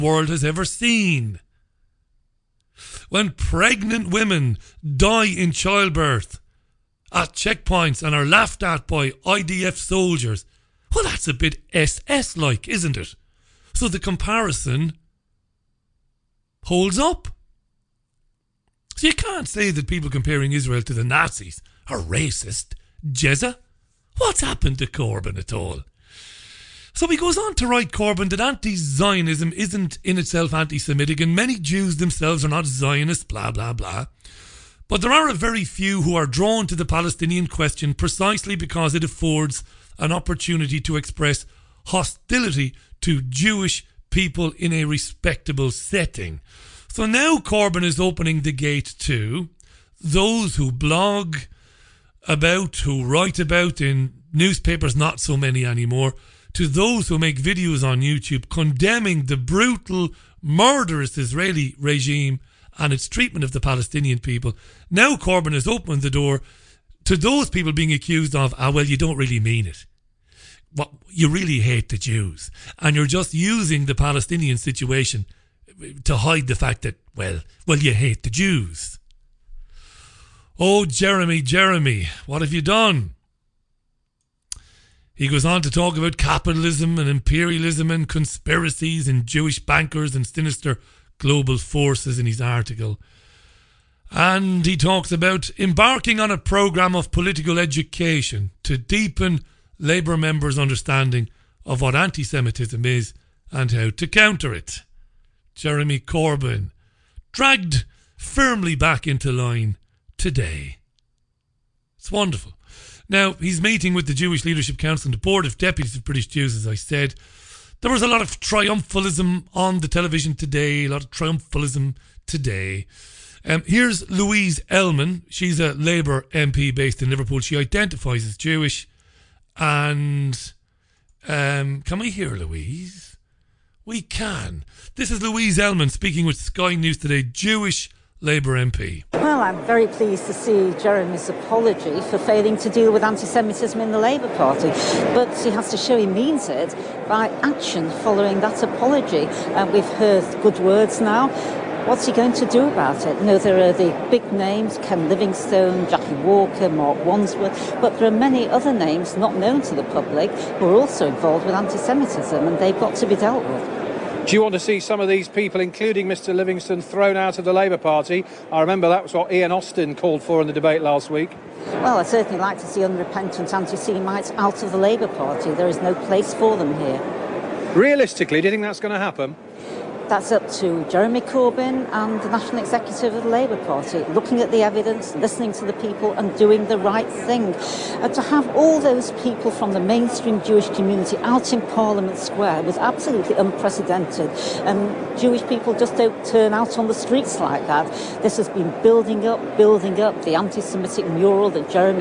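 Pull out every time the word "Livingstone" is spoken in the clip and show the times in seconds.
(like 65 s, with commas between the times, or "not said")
155 s, 166 s.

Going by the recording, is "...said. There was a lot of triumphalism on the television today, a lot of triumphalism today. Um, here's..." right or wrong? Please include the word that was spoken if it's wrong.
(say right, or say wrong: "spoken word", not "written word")
right.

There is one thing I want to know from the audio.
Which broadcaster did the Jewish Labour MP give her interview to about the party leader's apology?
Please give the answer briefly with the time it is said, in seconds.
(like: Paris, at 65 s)
Sky News, at 136 s.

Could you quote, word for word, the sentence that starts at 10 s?
Well, that's a bit SS like, isn't it?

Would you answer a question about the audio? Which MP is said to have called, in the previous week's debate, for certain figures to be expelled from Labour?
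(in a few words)
Ian Austin.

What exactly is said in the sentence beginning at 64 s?
Now Corbyn has opened the door to those people being accused of, ah, well, you don't really mean it.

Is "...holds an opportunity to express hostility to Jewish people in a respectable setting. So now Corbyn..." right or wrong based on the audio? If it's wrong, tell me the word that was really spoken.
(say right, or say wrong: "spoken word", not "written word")
wrong: "affords", not "holds".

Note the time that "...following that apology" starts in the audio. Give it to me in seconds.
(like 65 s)
148 s.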